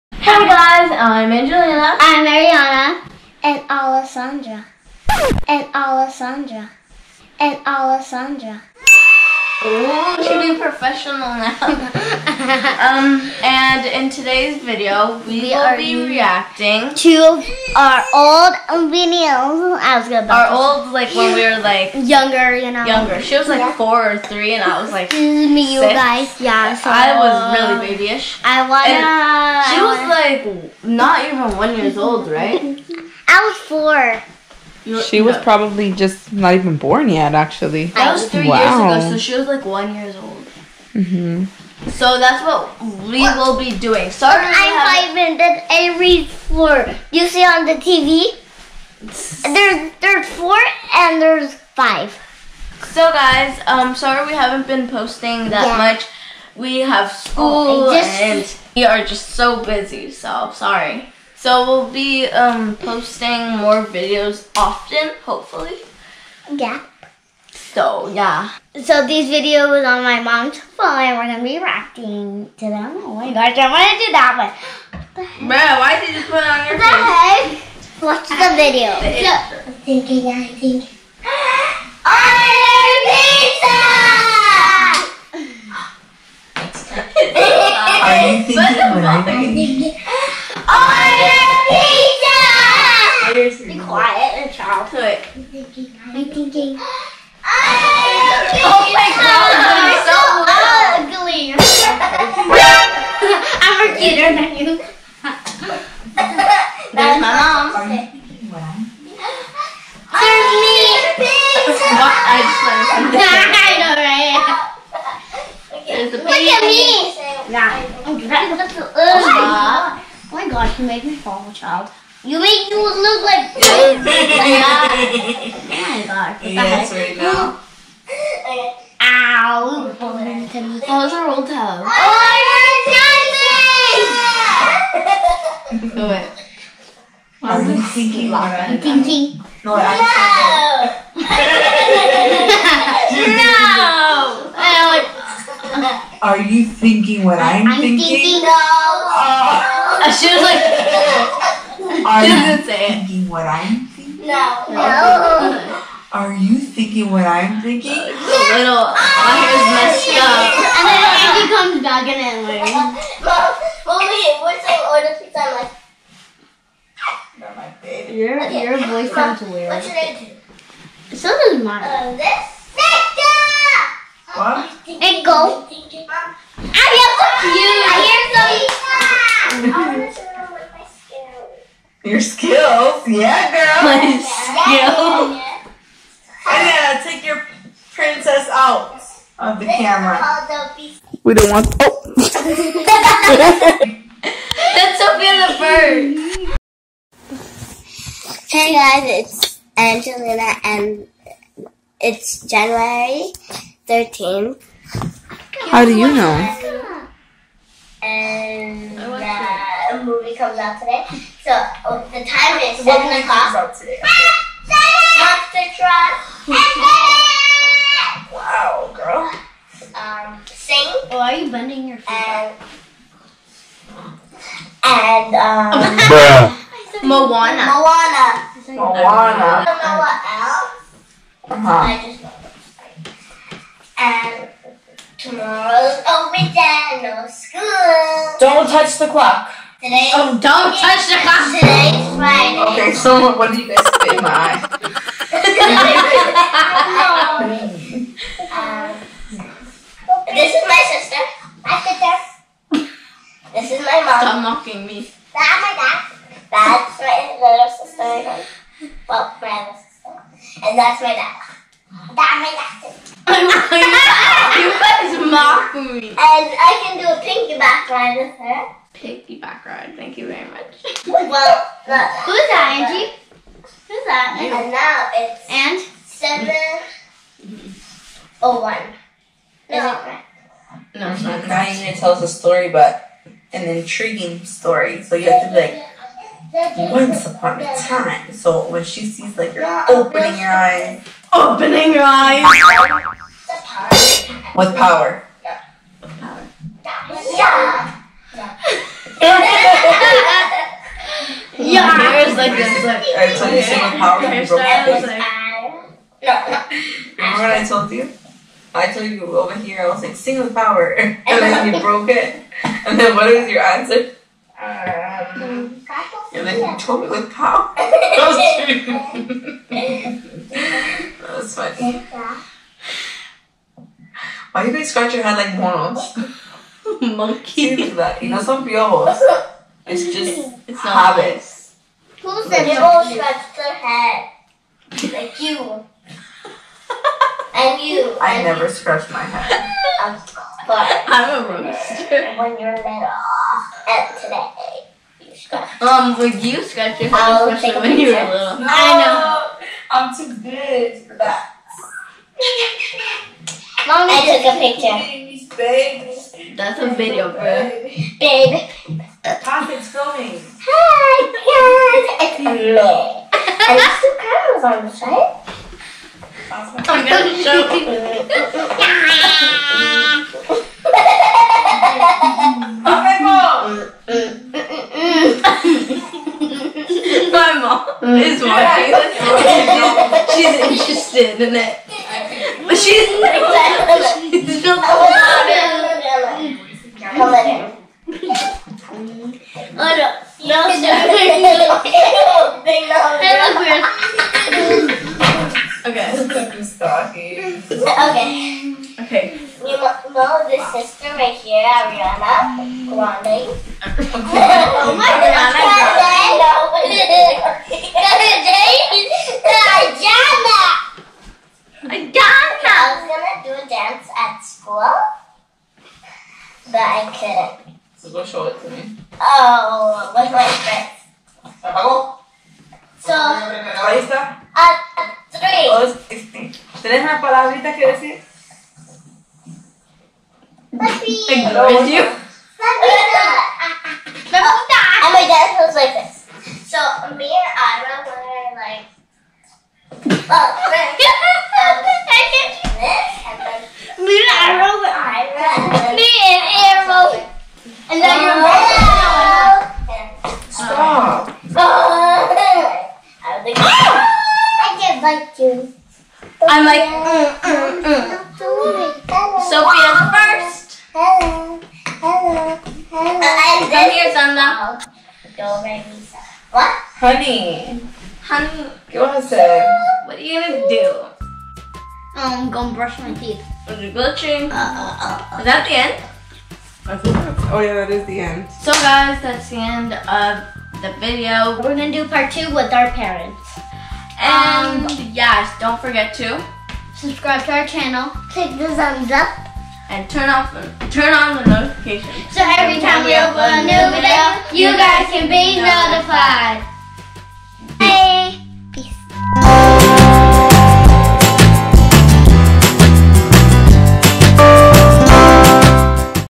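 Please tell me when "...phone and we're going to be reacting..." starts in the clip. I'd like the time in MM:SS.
01:10.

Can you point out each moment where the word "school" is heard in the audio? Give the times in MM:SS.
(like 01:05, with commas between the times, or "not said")
00:57, 03:57, 06:54.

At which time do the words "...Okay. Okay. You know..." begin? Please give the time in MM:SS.
06:37.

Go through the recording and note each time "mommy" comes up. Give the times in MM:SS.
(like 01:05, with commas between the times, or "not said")
02:43, 05:53.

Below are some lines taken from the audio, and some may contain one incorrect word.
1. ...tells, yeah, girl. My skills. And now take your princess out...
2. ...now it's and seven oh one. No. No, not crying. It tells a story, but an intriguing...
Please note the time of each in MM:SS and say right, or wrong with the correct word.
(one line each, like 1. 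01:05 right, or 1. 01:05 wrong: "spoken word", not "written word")
1. 03:02 wrong: "skills", not "tells"
2. 04:34 right.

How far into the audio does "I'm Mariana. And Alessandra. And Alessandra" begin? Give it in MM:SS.
00:01.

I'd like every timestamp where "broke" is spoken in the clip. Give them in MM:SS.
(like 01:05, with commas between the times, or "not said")
05:04, 05:11.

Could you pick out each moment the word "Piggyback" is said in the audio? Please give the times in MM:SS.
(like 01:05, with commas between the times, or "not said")
04:28.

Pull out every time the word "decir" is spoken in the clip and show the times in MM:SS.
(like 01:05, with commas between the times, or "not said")
07:07.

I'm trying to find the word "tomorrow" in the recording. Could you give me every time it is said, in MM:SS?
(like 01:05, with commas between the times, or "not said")
03:55.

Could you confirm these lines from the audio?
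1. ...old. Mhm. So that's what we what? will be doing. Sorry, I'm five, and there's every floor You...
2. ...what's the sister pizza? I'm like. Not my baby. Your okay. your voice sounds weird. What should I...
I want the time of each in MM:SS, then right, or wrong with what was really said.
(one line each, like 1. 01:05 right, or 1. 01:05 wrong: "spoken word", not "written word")
1. 00:40 right
2. 02:44 wrong: "order", not "sister".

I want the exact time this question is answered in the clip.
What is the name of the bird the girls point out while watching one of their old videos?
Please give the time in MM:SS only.
03:14.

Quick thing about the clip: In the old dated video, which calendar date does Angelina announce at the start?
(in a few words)
January 13th.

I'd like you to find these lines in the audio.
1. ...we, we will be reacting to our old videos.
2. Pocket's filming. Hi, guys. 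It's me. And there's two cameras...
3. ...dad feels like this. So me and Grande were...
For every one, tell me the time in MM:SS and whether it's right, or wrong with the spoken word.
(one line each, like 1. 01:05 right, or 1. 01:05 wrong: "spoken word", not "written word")
1. 00:15 right
2. 05:59 right
3. 07:15 wrong: "Ira", not "Grande".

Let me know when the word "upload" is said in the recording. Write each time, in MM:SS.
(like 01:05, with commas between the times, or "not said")
08:13.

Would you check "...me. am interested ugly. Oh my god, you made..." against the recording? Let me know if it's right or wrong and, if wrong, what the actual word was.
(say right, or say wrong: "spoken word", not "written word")
wrong: "dressed", not "interested".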